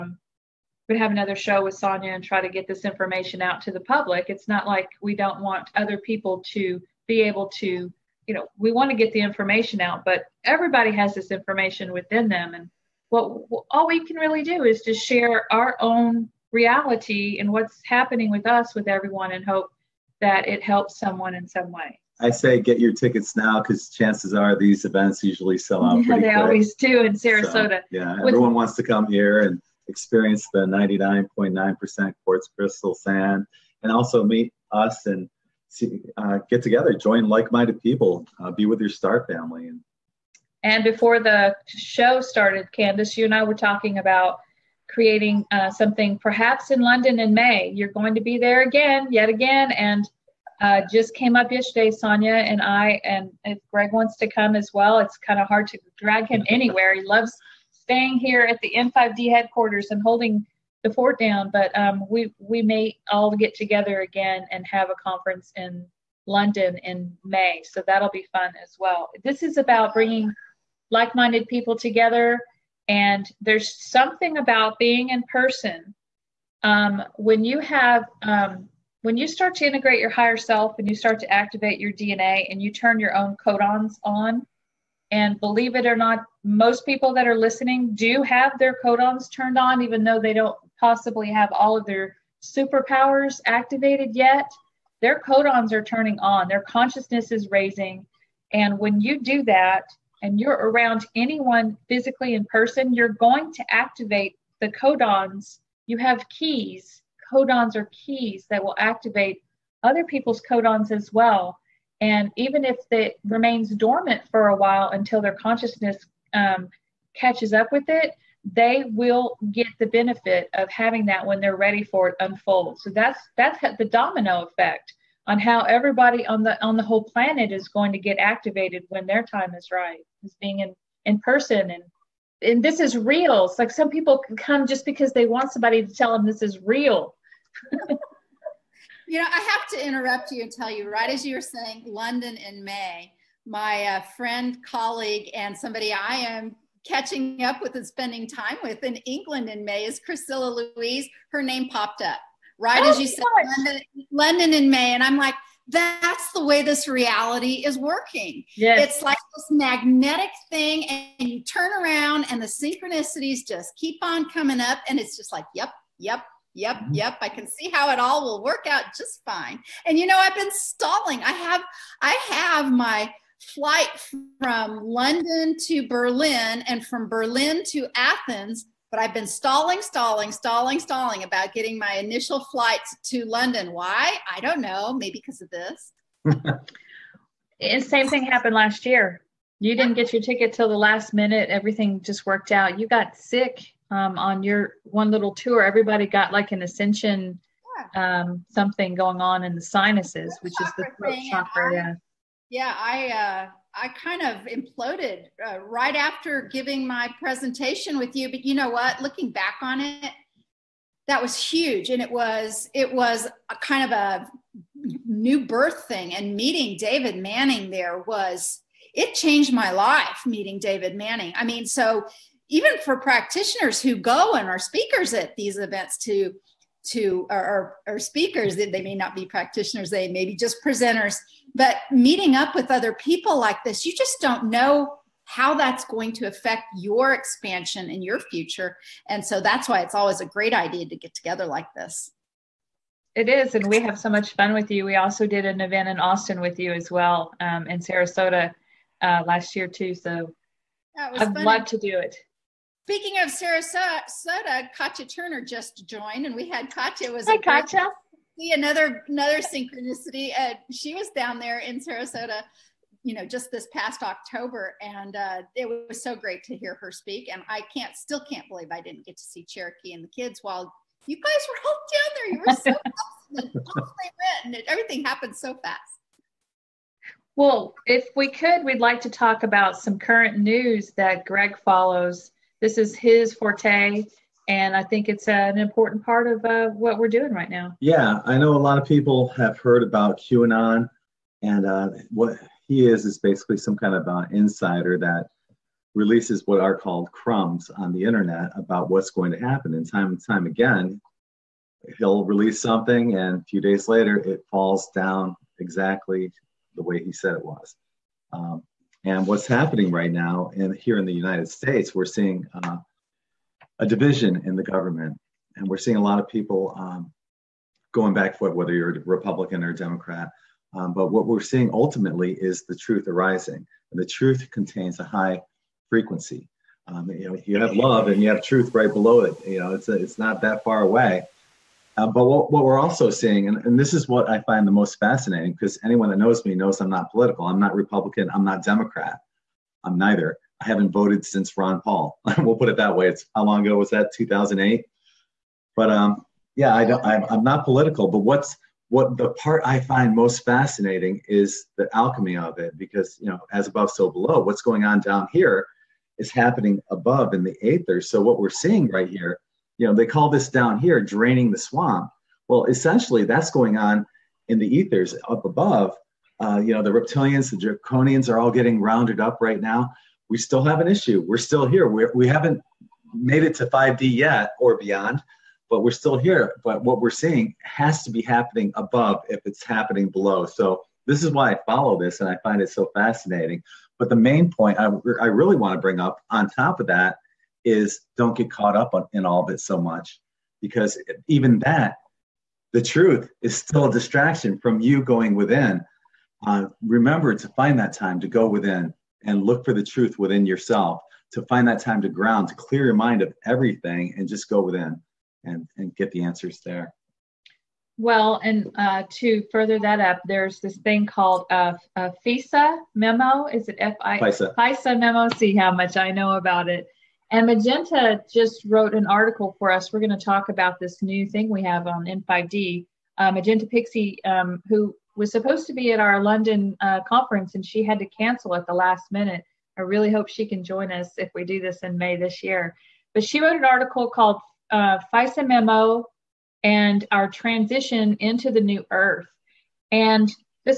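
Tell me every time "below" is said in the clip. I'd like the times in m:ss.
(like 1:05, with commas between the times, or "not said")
5:28, 5:54, 6:20.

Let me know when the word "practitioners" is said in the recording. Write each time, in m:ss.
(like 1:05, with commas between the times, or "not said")
3:42, 3:49.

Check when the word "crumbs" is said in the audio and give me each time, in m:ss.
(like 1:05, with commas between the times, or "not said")
4:57.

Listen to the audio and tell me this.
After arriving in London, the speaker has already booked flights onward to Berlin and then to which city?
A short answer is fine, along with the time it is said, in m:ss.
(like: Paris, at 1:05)
Athens, at 2:57.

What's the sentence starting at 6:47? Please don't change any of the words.
Well, and uh, to further that up, there's this thing called a FISA memo.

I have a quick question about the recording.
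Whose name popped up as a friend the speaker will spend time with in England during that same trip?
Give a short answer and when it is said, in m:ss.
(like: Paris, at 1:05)
Priscilla Louise, at 2:29.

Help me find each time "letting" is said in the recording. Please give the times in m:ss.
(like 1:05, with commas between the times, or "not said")
not said.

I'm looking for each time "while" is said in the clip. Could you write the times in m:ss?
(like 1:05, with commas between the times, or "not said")
1:54, 4:30.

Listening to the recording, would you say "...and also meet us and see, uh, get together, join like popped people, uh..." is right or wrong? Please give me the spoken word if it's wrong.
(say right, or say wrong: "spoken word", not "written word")
wrong: "minded", not "popped".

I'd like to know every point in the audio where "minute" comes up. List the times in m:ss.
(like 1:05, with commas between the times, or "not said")
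3:11, 7:09.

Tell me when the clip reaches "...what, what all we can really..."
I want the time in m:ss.
0:13.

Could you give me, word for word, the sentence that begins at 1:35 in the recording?
Their codons are turning on, their consciousness is raising.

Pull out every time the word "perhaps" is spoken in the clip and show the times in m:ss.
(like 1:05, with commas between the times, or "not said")
0:46.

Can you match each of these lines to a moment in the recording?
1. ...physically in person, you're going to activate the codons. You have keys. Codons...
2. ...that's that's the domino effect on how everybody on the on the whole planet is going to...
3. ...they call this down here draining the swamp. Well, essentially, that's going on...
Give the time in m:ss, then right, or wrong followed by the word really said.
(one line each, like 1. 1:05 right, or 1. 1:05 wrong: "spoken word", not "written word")
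1. 1:41 right
2. 2:02 right
3. 5:59 right.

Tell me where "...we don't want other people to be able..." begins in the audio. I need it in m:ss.
0:05.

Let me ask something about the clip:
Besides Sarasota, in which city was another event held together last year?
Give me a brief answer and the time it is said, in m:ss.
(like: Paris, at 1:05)
Austin, at 4:05.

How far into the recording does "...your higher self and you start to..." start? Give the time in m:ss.
1:19.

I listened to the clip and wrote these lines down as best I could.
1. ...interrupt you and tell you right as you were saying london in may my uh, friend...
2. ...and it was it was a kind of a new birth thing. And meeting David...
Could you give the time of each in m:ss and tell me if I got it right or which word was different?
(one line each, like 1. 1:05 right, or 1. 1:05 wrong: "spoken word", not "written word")
1. 2:19 right
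2. 3:31 right.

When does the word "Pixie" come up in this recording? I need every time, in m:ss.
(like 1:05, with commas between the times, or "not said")
7:03.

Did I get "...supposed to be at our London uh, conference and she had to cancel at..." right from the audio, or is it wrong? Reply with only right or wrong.
right.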